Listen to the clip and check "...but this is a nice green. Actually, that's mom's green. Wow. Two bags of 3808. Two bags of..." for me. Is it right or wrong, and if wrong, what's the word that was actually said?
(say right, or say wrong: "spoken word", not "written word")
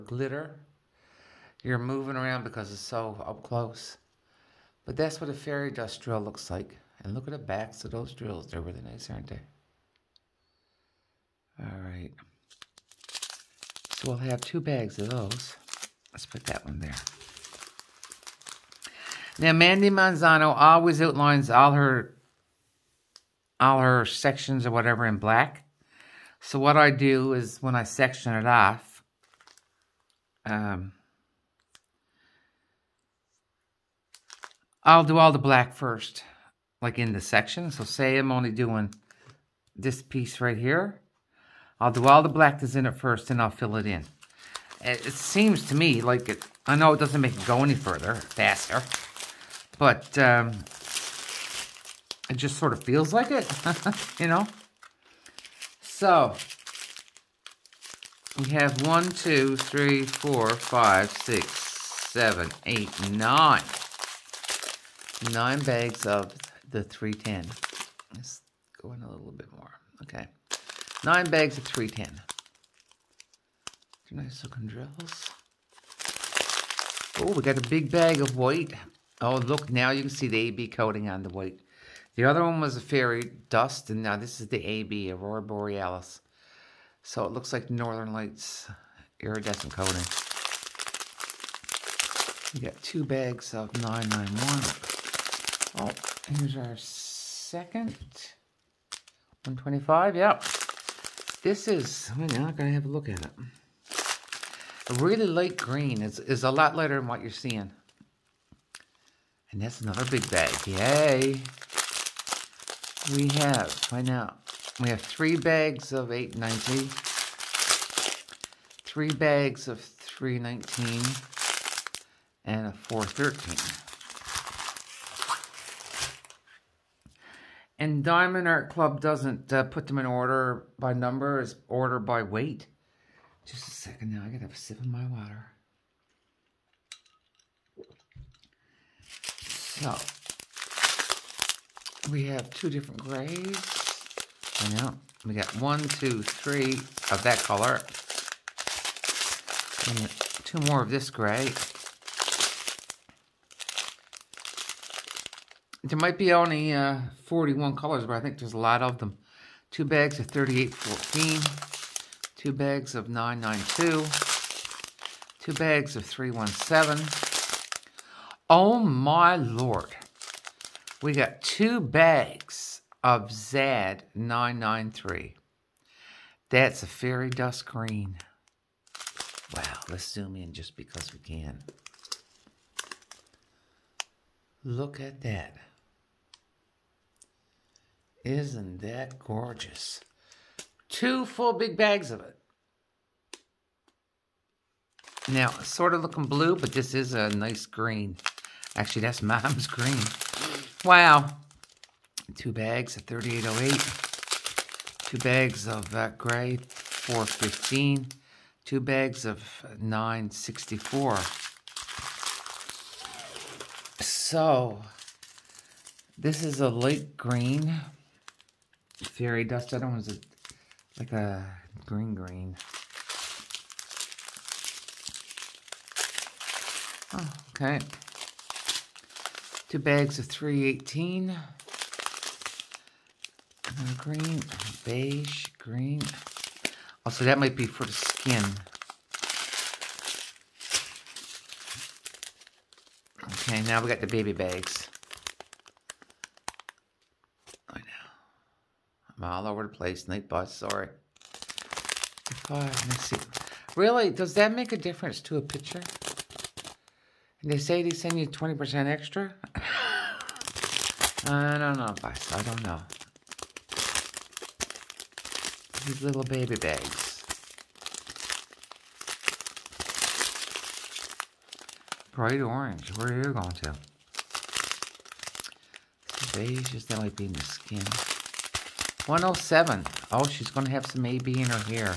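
right.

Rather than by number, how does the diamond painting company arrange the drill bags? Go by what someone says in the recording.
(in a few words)
By weight.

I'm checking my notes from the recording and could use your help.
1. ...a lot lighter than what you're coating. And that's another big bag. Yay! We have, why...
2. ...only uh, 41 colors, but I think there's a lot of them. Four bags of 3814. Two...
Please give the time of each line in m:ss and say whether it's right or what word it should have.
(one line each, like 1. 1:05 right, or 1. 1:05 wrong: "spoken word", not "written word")
1. 1:46 wrong: "seeing", not "coating"
2. 2:36 wrong: "Two", not "Four".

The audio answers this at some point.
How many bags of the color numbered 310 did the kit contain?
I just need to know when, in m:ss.
1:05.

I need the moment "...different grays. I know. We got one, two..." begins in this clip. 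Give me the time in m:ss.
2:22.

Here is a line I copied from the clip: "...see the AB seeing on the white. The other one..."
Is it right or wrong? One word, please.
wrong.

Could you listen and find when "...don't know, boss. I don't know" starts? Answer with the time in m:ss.
4:21.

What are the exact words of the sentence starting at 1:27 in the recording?
So it looks like Northern Lights iridescent coating.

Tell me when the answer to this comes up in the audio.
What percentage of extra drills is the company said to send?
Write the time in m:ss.
4:18.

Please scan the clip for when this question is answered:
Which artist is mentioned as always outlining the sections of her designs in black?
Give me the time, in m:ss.
0:19.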